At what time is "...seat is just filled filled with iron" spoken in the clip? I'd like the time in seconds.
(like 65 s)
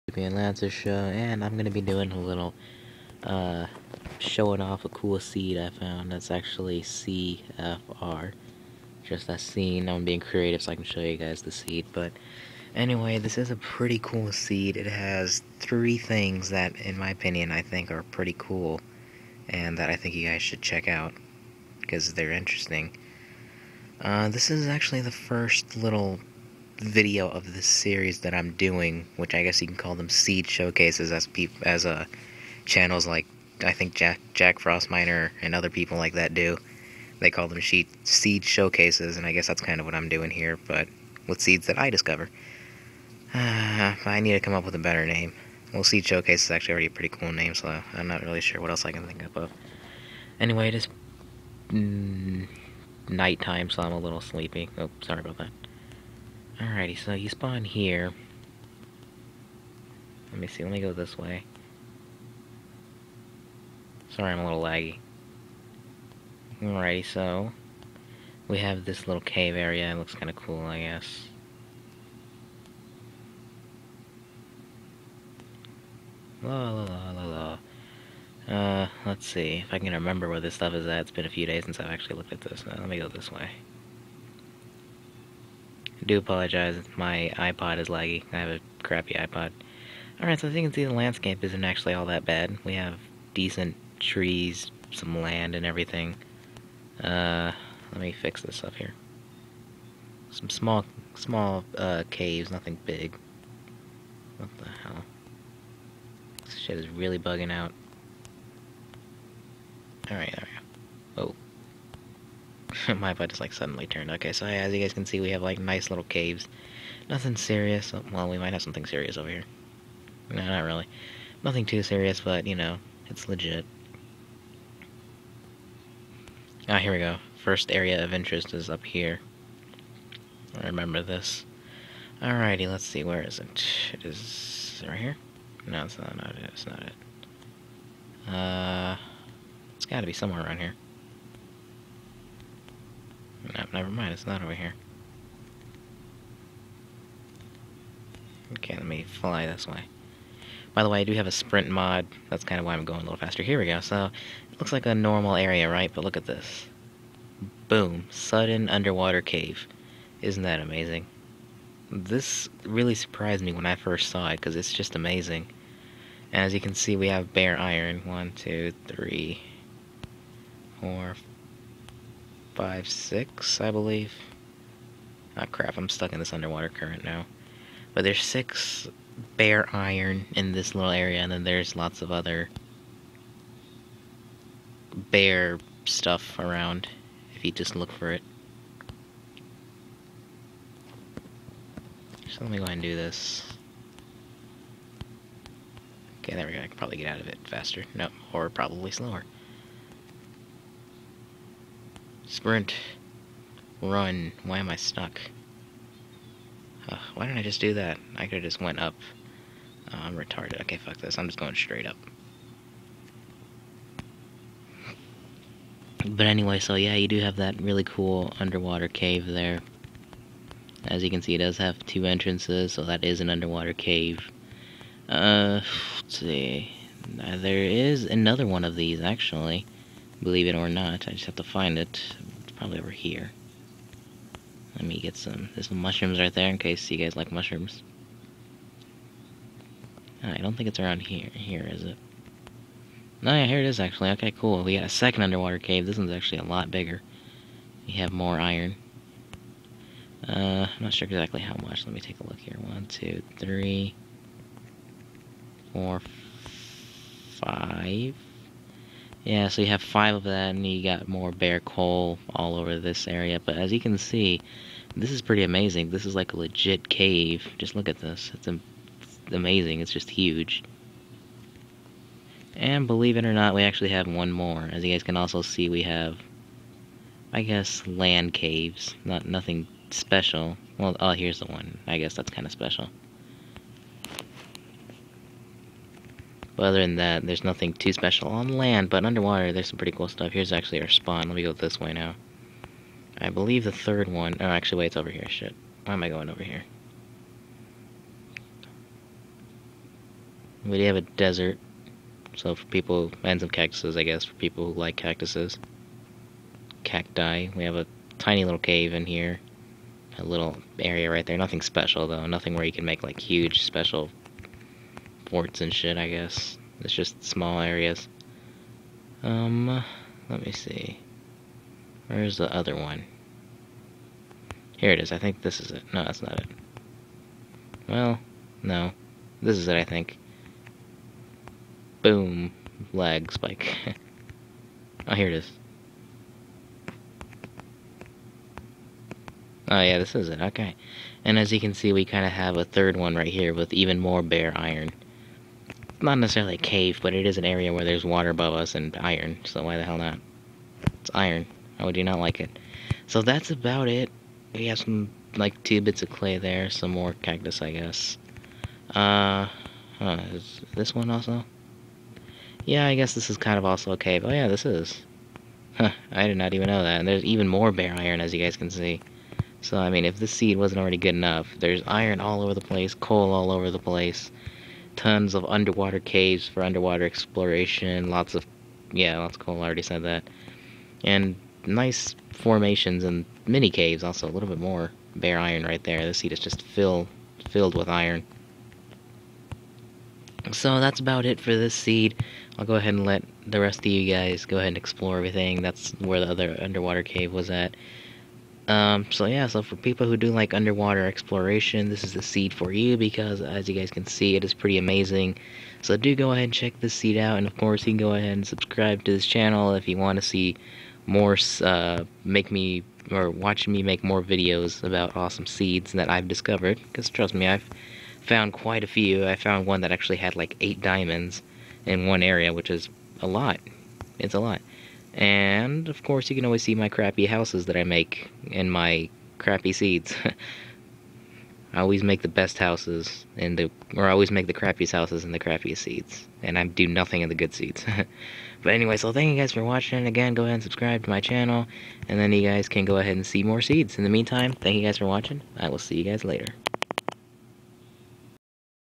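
386 s.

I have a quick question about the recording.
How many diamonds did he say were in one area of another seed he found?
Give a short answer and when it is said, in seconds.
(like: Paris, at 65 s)
8, at 420 s.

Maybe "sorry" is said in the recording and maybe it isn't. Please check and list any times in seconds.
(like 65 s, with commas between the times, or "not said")
55 s, 64 s.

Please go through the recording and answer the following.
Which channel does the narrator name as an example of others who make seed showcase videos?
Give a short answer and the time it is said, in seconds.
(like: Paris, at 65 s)
Jack Frost Miner, at 34 s.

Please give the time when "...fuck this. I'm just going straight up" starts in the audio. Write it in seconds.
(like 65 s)
210 s.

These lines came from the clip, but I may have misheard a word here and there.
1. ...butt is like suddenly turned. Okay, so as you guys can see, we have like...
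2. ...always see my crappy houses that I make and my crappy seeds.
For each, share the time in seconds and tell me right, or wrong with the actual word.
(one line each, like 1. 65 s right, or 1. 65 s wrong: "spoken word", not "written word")
1. 113 s right
2. 426 s right.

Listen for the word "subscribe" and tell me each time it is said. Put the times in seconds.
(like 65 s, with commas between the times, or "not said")
408 s, 440 s.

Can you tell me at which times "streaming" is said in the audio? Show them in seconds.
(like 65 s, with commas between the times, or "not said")
not said.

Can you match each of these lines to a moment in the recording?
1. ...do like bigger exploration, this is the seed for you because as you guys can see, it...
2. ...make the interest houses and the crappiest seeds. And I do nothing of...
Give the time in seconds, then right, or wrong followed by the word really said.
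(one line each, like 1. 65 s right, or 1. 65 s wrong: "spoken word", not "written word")
1. 400 s wrong: "underwater", not "bigger"
2. 434 s wrong: "crappiest", not "interest".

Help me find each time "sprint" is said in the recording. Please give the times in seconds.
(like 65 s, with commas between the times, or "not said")
151 s, 202 s.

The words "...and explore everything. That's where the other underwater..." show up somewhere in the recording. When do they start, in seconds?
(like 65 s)
394 s.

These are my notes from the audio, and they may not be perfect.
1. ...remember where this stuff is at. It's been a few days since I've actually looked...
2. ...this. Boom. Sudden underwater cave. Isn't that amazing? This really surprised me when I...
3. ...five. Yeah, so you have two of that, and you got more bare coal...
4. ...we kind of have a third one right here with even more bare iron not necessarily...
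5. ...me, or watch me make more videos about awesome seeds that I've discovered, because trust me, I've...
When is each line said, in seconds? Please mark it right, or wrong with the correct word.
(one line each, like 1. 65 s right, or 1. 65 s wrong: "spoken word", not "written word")
1. 79 s right
2. 156 s right
3. 257 s wrong: "five", not "two"
4. 341 s right
5. 412 s right.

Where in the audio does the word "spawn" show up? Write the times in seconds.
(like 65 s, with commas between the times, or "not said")
57 s, 290 s.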